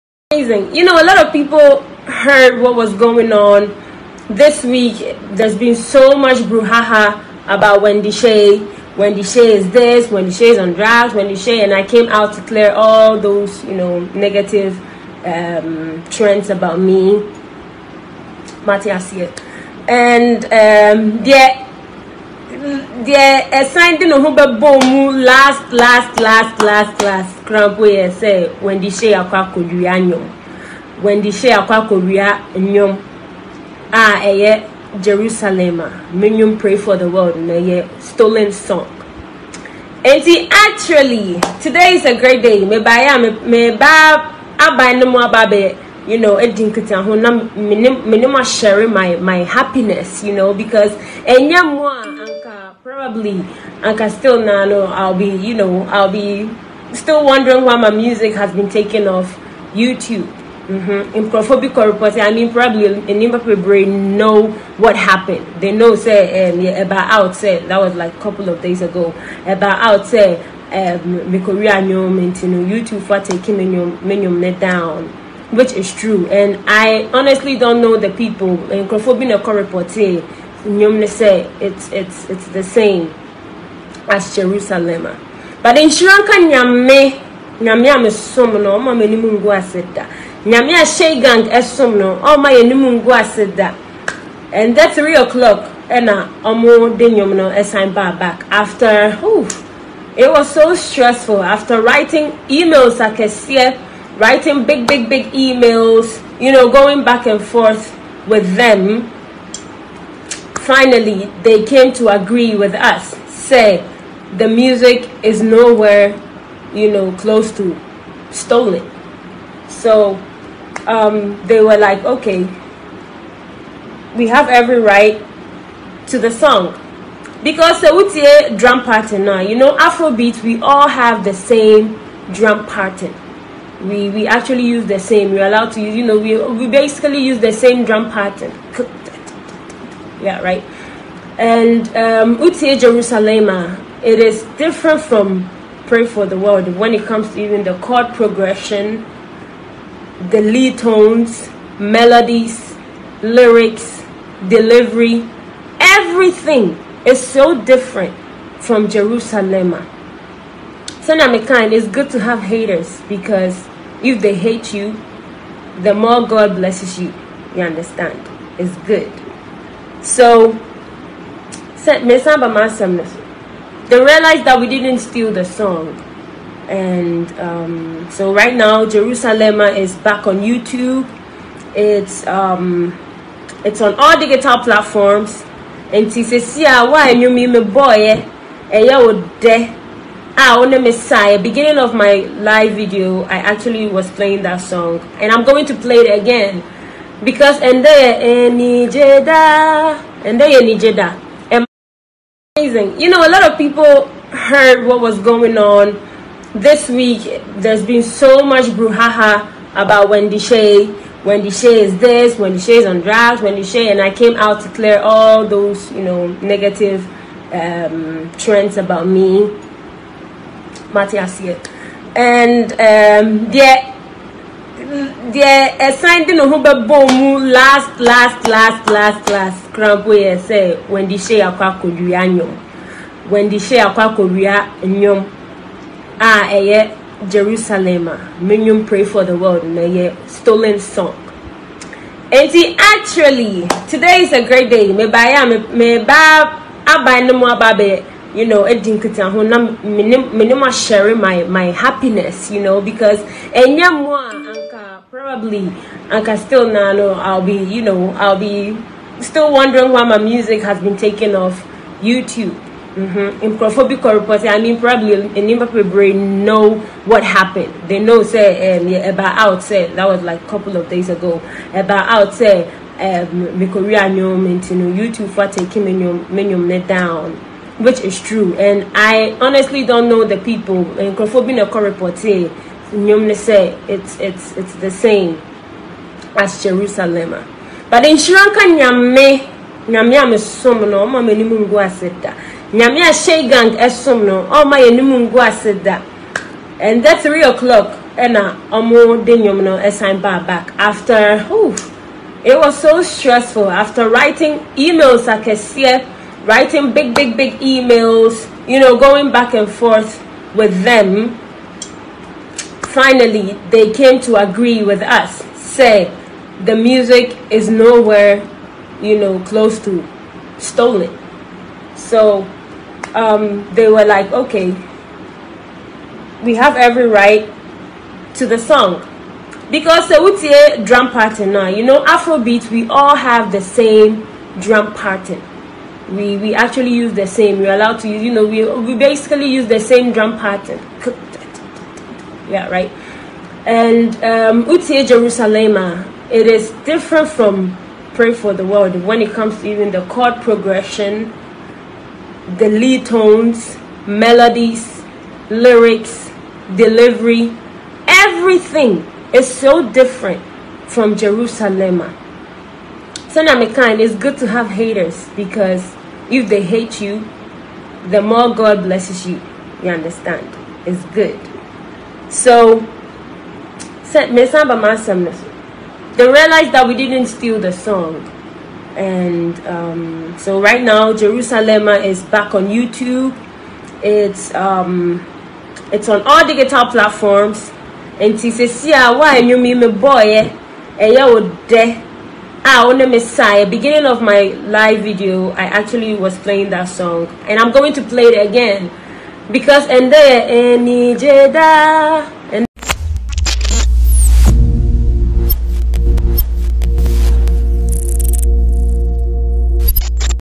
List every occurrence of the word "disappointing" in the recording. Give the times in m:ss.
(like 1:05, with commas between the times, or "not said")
not said.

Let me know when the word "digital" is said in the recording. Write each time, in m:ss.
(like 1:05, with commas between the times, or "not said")
3:04, 6:26.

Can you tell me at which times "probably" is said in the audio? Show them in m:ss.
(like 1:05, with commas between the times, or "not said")
0:52, 1:02, 4:15, 4:24.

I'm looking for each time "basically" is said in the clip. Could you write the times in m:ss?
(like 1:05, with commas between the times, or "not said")
2:16, 5:38.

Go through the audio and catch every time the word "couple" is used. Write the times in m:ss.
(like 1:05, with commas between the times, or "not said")
1:08, 4:30.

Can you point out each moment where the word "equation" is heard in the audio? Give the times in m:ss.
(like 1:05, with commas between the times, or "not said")
not said.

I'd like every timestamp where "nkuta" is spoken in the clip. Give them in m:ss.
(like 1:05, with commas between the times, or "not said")
0:46.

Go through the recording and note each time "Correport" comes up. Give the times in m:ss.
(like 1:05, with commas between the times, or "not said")
1:19.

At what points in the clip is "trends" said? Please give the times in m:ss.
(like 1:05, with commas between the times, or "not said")
0:16, 3:38.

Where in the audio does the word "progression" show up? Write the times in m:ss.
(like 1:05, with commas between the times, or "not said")
2:28, 5:50.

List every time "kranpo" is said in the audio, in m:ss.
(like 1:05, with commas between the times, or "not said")
0:27, 3:49.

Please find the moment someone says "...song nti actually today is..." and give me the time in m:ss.
0:38.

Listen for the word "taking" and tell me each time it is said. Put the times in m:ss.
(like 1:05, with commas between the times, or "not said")
1:13, 4:35.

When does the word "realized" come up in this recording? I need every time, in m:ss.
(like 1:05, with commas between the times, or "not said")
2:52, 6:14.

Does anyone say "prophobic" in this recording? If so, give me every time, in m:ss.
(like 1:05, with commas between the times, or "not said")
1:01, 4:23, 4:41.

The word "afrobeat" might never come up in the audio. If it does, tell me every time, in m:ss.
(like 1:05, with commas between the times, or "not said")
2:09, 5:32.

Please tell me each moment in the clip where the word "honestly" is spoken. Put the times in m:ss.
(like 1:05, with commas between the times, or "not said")
1:17, 4:39.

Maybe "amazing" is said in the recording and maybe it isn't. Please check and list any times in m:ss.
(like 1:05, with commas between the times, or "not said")
0:00, 3:22.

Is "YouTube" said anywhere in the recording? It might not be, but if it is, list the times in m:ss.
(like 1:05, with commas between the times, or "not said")
0:59, 1:11, 3:00, 4:21, 4:34, 6:22.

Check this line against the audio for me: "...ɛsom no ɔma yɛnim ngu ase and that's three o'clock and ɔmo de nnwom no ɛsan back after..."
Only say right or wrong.
right.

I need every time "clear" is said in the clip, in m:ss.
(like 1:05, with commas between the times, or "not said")
0:12, 3:34.